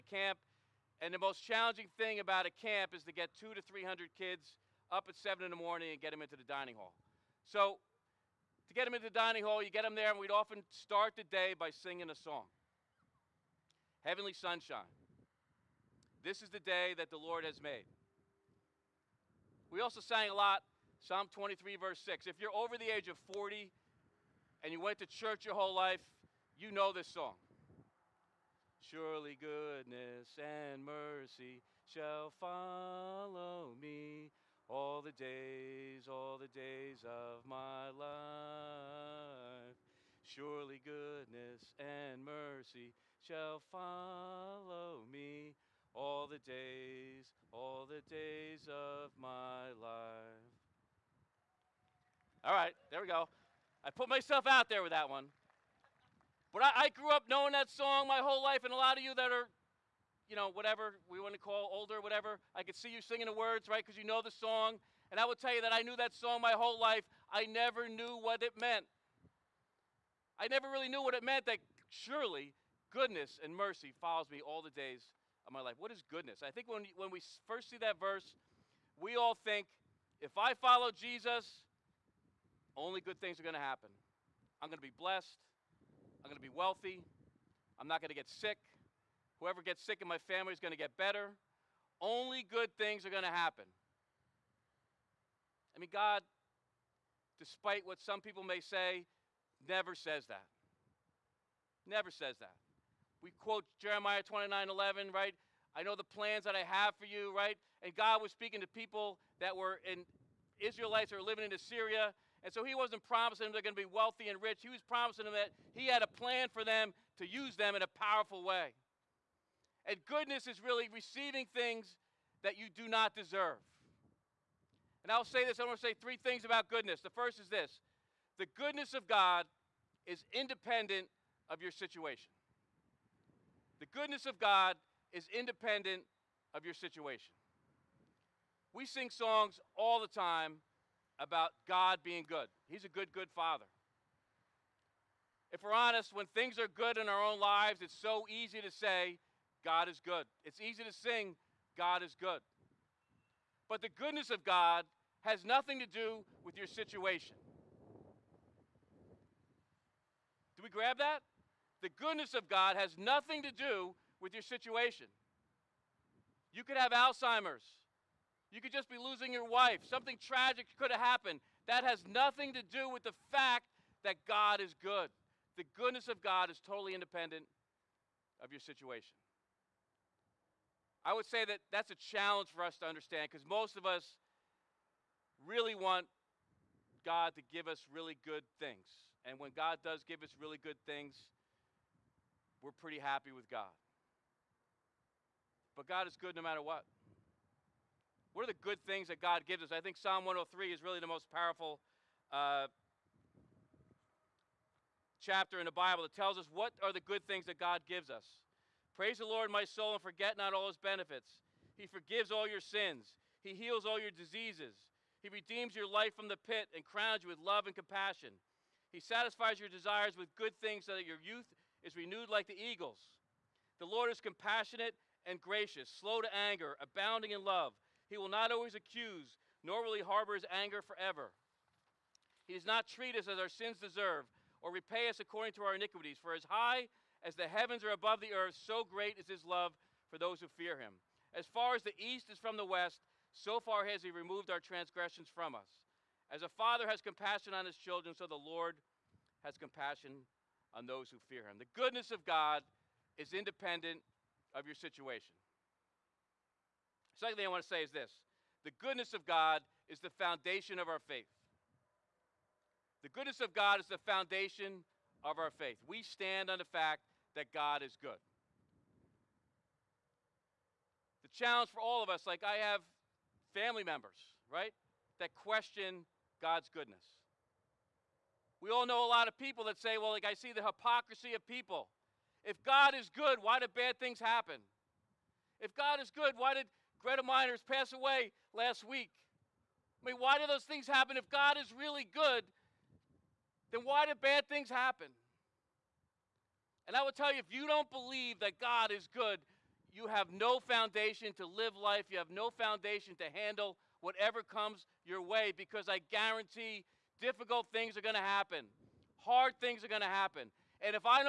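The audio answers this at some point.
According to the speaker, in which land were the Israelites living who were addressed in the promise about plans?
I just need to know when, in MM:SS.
01:51.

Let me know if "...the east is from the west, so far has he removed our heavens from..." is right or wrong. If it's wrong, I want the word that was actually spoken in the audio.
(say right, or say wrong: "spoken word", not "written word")
wrong: "transgressions", not "heavens".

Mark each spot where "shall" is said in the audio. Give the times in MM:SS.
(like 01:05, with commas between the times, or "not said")
00:31, 00:43.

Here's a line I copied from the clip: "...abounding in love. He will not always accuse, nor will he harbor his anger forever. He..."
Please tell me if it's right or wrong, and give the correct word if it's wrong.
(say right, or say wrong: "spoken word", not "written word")
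right.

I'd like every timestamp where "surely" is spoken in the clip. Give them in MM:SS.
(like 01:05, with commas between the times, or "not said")
00:28, 00:40, 01:11.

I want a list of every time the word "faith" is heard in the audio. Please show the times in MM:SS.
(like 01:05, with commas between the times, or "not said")
04:21, 04:25.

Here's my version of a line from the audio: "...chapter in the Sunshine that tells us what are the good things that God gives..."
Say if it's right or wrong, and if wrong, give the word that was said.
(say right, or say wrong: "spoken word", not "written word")
wrong: "Bible", not "Sunshine".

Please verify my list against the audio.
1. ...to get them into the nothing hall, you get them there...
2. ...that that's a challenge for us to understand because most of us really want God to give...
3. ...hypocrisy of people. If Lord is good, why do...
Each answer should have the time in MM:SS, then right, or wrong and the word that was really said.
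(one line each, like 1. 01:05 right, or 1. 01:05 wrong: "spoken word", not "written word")
1. 00:08 wrong: "dining", not "nothing"
2. 03:01 right
3. 04:40 wrong: "God", not "Lord".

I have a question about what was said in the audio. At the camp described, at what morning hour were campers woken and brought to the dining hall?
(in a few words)
7.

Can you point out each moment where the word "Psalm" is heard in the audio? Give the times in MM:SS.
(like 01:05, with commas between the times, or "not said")
00:20, 03:19.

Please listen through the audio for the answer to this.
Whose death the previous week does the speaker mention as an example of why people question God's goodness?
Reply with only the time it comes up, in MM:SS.
04:47.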